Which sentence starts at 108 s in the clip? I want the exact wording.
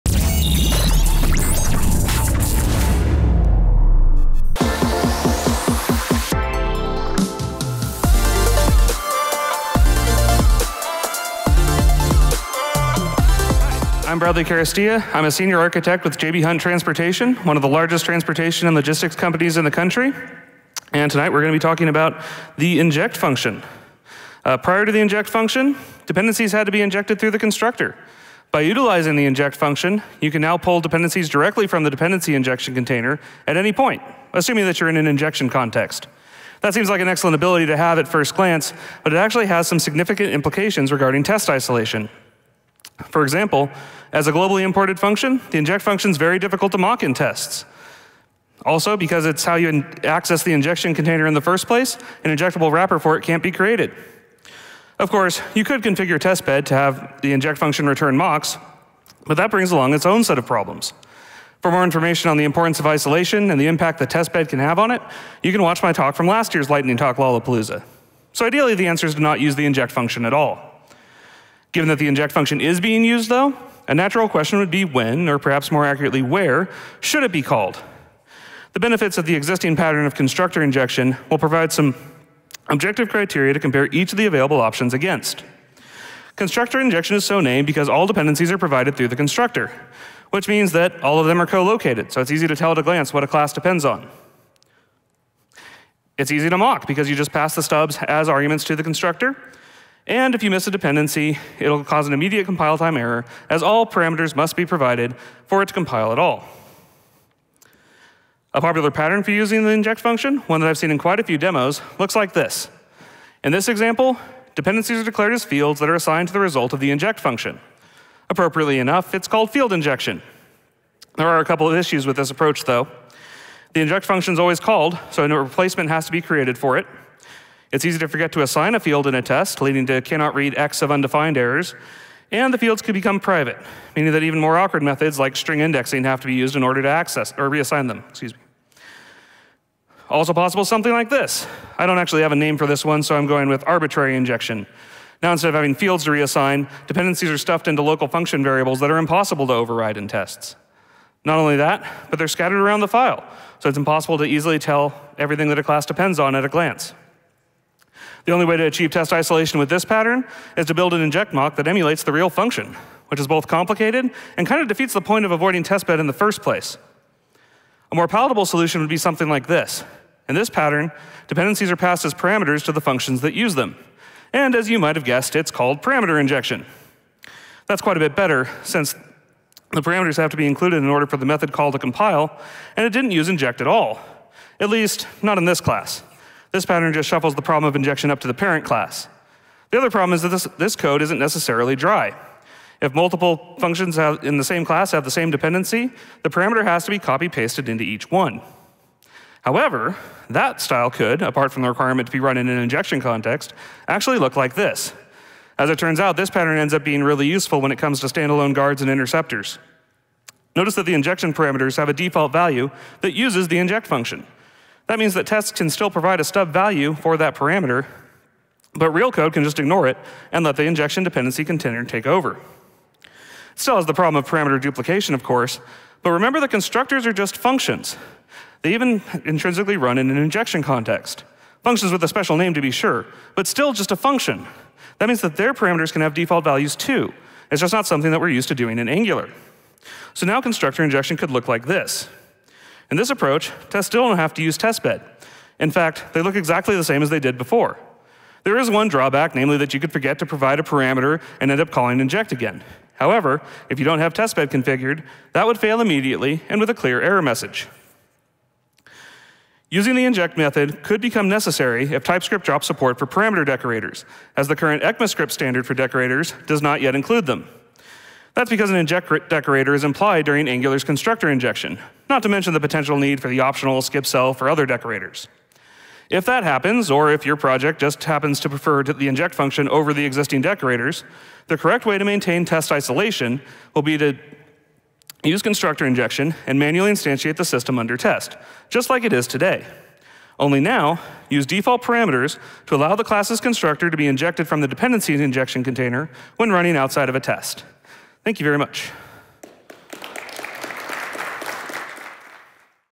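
A popular pattern for using the inject function, one that I've seen in quite a few demos, looks like this.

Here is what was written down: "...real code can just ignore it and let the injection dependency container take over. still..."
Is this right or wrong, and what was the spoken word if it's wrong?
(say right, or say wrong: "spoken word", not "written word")
right.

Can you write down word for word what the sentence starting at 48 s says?
Also, because it's how you access the injection container in the first place, an injectable wrapper for it can't be created.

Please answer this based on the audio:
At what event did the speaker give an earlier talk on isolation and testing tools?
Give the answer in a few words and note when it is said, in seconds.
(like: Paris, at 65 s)
Lightning Talk Lollapalooza, at 66 s.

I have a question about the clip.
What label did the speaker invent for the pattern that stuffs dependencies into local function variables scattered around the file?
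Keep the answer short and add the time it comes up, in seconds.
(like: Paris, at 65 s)
Arbitrary injection, at 143 s.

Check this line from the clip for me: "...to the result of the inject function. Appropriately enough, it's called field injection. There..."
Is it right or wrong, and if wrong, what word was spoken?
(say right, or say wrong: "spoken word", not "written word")
right.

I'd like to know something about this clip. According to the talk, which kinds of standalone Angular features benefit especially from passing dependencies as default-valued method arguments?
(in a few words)
Guards and interceptors.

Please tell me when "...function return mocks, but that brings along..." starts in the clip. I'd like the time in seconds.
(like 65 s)
57 s.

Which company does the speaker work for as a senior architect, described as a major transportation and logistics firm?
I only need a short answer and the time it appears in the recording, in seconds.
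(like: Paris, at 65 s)
JB Hunt Transportation, at 16 s.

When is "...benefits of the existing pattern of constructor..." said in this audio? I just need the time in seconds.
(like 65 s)
78 s.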